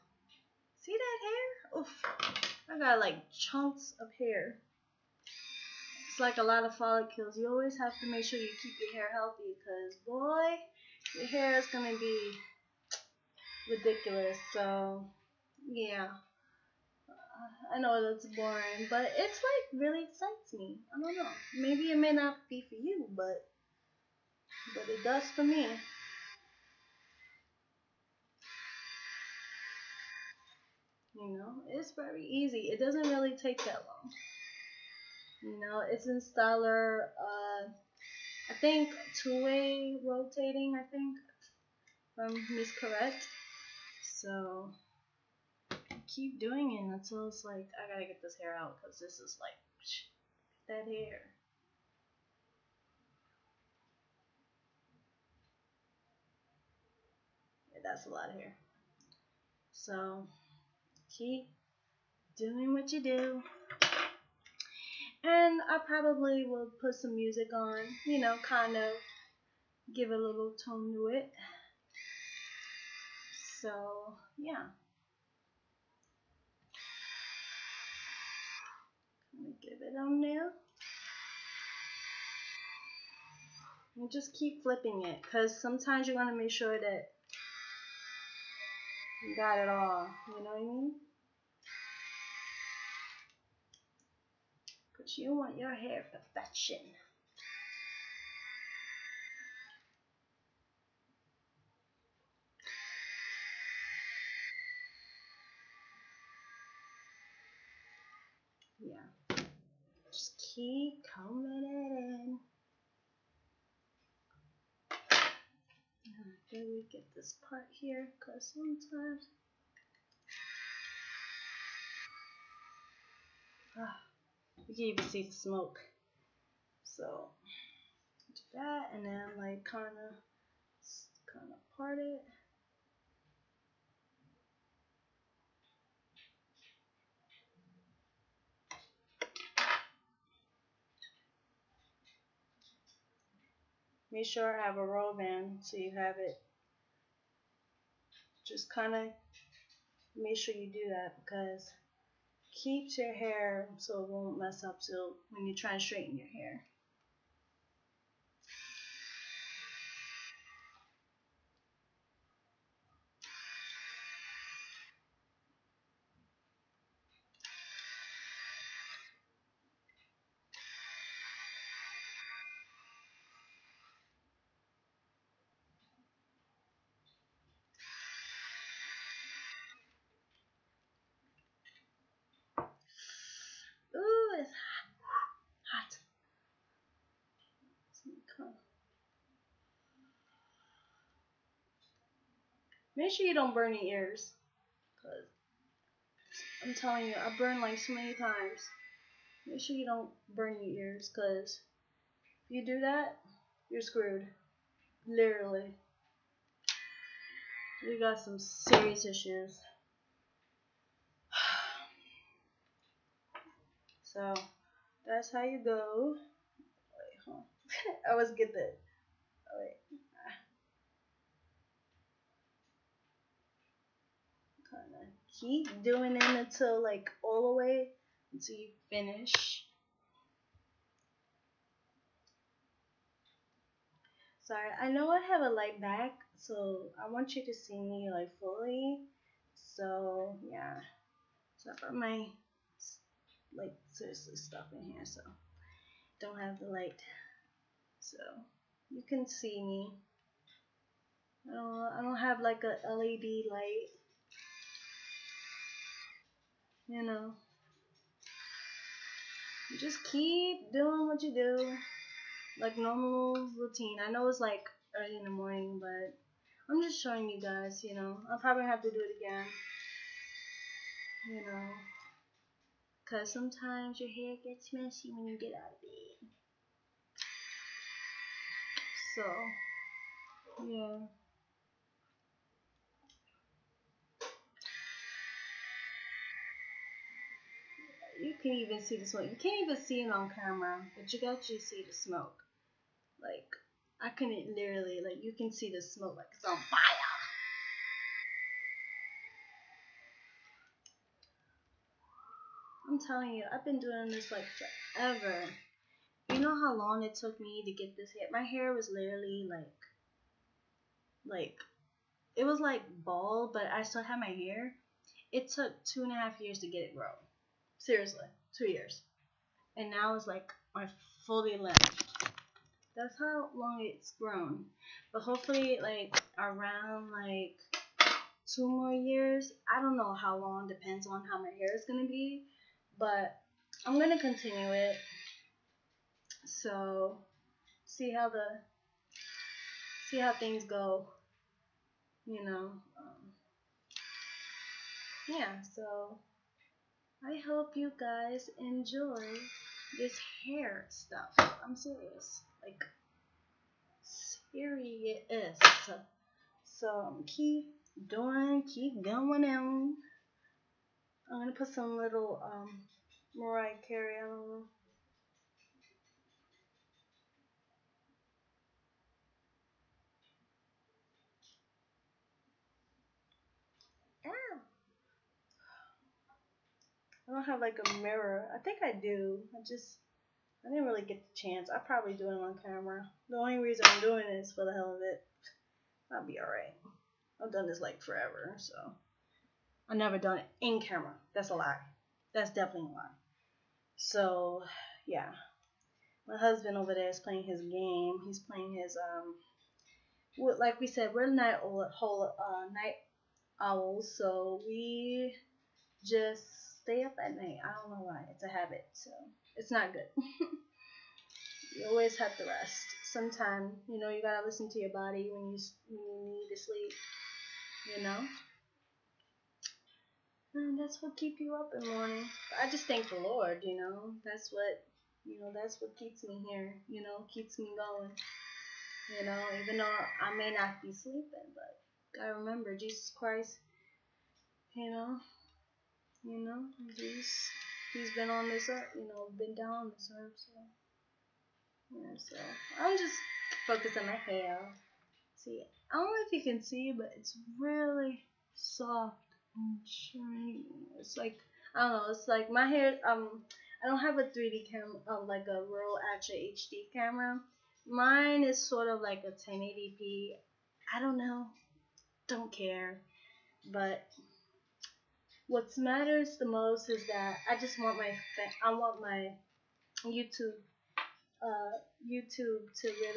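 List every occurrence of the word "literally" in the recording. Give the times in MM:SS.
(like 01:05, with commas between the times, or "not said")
03:25, 04:54, 05:08.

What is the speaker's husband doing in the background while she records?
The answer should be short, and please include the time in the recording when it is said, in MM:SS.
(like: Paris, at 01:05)
Playing his game, at 06:37.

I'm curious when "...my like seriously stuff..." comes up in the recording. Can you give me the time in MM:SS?
04:01.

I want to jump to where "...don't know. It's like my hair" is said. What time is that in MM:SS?
07:31.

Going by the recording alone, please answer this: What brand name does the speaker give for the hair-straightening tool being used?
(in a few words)
Instyler.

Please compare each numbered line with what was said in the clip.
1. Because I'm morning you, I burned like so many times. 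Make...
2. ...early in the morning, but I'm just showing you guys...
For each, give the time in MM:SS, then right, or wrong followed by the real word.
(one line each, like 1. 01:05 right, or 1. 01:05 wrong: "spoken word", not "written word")
1. 03:15 wrong: "telling", not "morning"
2. 04:24 right.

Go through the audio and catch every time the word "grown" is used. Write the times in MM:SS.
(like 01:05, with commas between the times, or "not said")
05:16, 05:24.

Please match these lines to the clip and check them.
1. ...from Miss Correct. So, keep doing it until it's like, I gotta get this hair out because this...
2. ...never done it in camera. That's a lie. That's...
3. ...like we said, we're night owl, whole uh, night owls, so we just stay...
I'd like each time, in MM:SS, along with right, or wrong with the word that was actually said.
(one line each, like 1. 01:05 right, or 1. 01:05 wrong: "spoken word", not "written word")
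1. 00:42 right
2. 06:29 right
3. 06:40 right.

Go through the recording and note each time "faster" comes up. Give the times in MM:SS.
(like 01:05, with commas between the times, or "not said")
not said.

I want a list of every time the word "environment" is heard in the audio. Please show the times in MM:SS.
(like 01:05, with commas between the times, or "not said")
not said.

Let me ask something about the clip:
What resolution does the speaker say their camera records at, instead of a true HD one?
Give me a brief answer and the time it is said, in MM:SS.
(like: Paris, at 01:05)
1080p, at 07:39.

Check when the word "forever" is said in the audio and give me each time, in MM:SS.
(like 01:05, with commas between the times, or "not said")
05:04, 06:28.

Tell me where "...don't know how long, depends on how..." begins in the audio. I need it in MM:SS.
05:29.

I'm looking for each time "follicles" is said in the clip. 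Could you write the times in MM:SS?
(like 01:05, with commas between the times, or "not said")
00:06.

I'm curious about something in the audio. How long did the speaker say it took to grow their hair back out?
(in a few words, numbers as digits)
2 and a half years.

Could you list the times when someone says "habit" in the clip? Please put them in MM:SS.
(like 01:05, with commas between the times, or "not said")
06:48.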